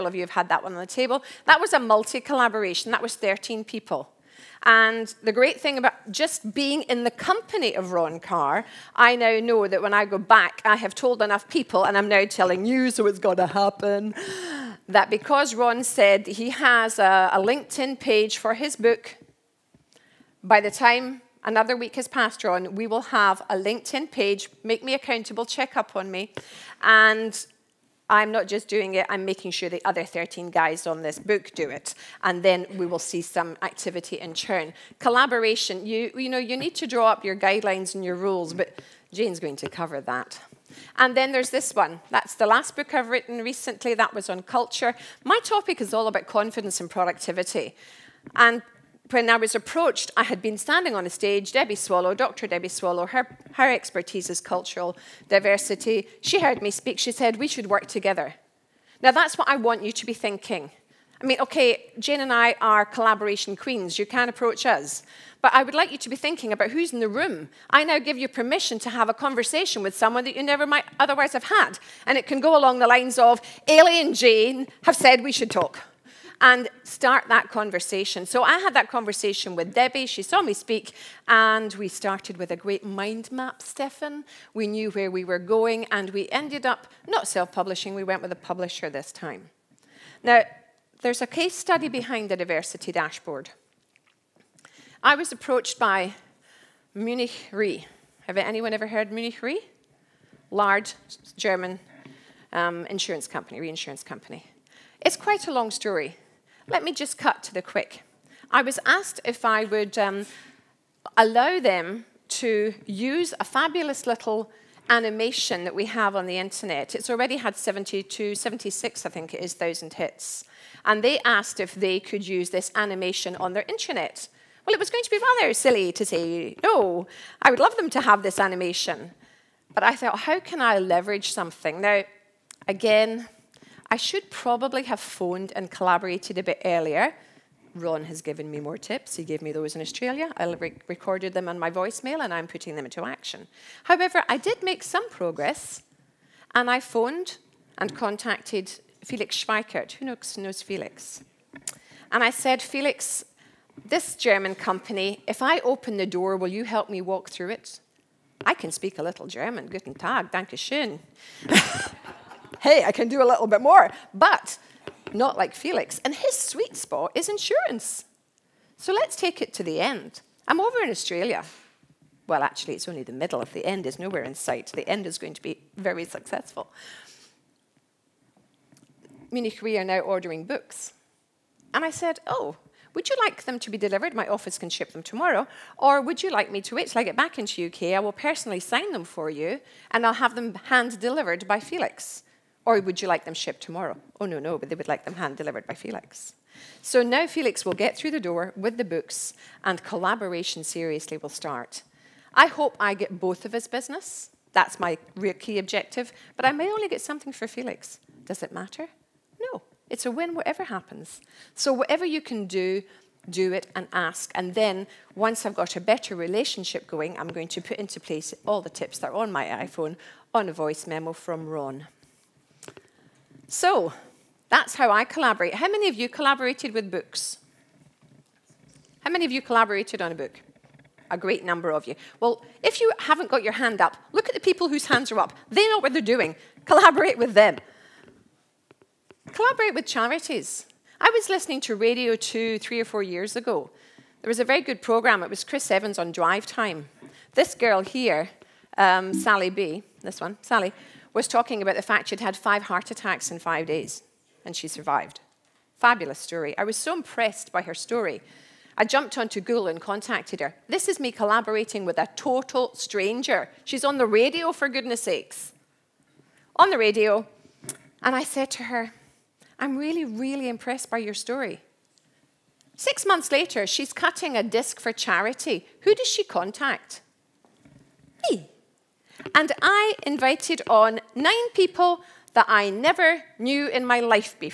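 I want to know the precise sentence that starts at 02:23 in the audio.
However, I did make some progress and I phoned and contacted Felix Schweikert.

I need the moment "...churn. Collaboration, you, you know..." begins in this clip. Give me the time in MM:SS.
00:34.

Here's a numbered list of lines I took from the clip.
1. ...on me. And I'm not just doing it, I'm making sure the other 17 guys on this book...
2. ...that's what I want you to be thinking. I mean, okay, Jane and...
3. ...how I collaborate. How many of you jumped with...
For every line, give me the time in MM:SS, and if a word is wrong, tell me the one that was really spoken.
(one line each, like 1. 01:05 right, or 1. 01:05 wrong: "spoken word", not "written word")
1. 00:25 wrong: "13", not "17"
2. 00:59 right
3. 03:44 wrong: "collaborated", not "jumped".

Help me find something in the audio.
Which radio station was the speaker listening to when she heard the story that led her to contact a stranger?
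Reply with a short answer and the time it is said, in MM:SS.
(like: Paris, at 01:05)
Radio 2, at 04:01.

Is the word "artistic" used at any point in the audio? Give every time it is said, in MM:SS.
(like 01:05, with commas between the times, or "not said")
not said.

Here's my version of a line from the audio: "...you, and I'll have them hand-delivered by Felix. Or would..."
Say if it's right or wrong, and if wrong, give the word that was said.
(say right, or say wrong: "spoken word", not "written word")
right.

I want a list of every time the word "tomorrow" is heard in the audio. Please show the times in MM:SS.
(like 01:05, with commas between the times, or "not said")
03:05, 03:13.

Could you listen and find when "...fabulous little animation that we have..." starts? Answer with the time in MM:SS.
01:53.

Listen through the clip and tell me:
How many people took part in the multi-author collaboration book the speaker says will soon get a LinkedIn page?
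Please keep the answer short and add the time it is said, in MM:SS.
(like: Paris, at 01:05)
13, at 00:02.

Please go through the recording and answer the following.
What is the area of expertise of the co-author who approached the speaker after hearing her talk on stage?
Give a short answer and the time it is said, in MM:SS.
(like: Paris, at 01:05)
Cultural diversity, at 00:54.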